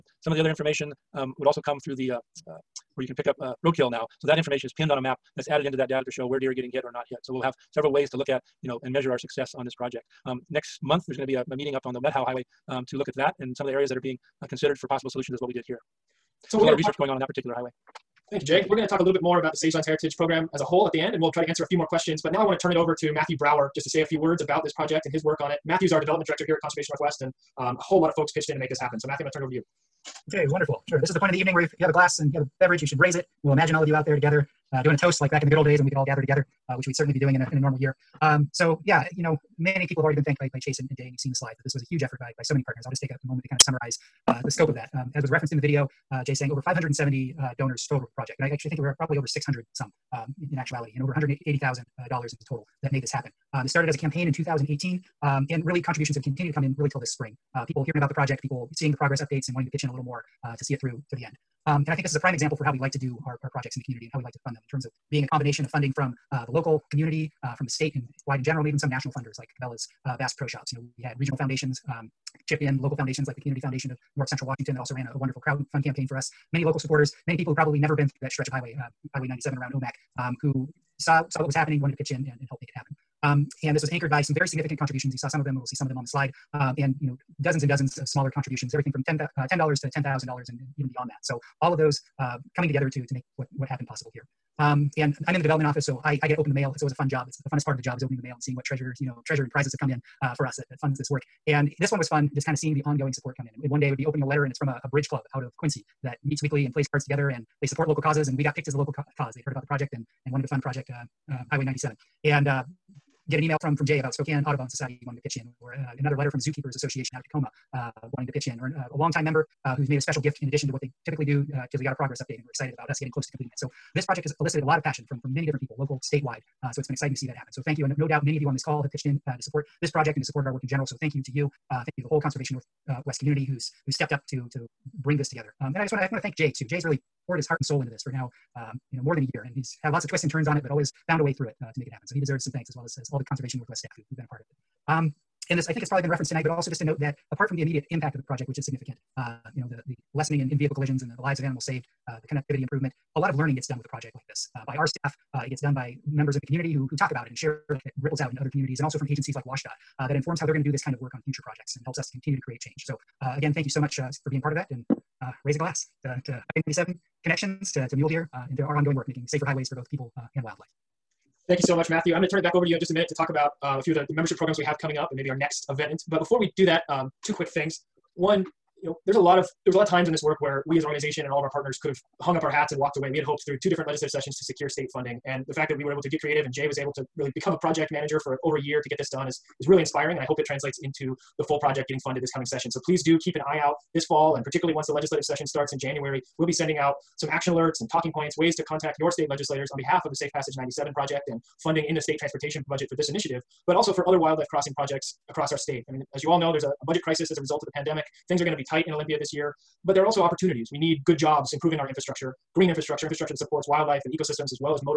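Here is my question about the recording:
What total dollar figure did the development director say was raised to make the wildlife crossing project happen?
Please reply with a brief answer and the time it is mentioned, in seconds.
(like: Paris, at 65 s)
$180,000, at 51 s.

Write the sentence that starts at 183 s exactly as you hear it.
We had hoped through two different legislative sessions to secure state funding.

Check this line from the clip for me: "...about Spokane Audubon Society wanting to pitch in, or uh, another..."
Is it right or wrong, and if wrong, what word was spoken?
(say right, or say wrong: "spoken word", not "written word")
right.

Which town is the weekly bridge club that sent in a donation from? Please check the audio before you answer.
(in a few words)
Quincy.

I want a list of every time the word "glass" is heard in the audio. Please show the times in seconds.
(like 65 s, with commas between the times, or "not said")
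31 s, 165 s.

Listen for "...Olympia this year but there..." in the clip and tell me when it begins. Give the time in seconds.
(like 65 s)
208 s.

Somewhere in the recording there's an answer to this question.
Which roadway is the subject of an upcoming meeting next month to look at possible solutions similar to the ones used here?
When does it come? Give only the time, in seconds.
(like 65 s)
11 s.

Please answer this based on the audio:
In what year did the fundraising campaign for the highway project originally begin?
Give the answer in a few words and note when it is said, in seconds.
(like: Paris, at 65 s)
2018, at 54 s.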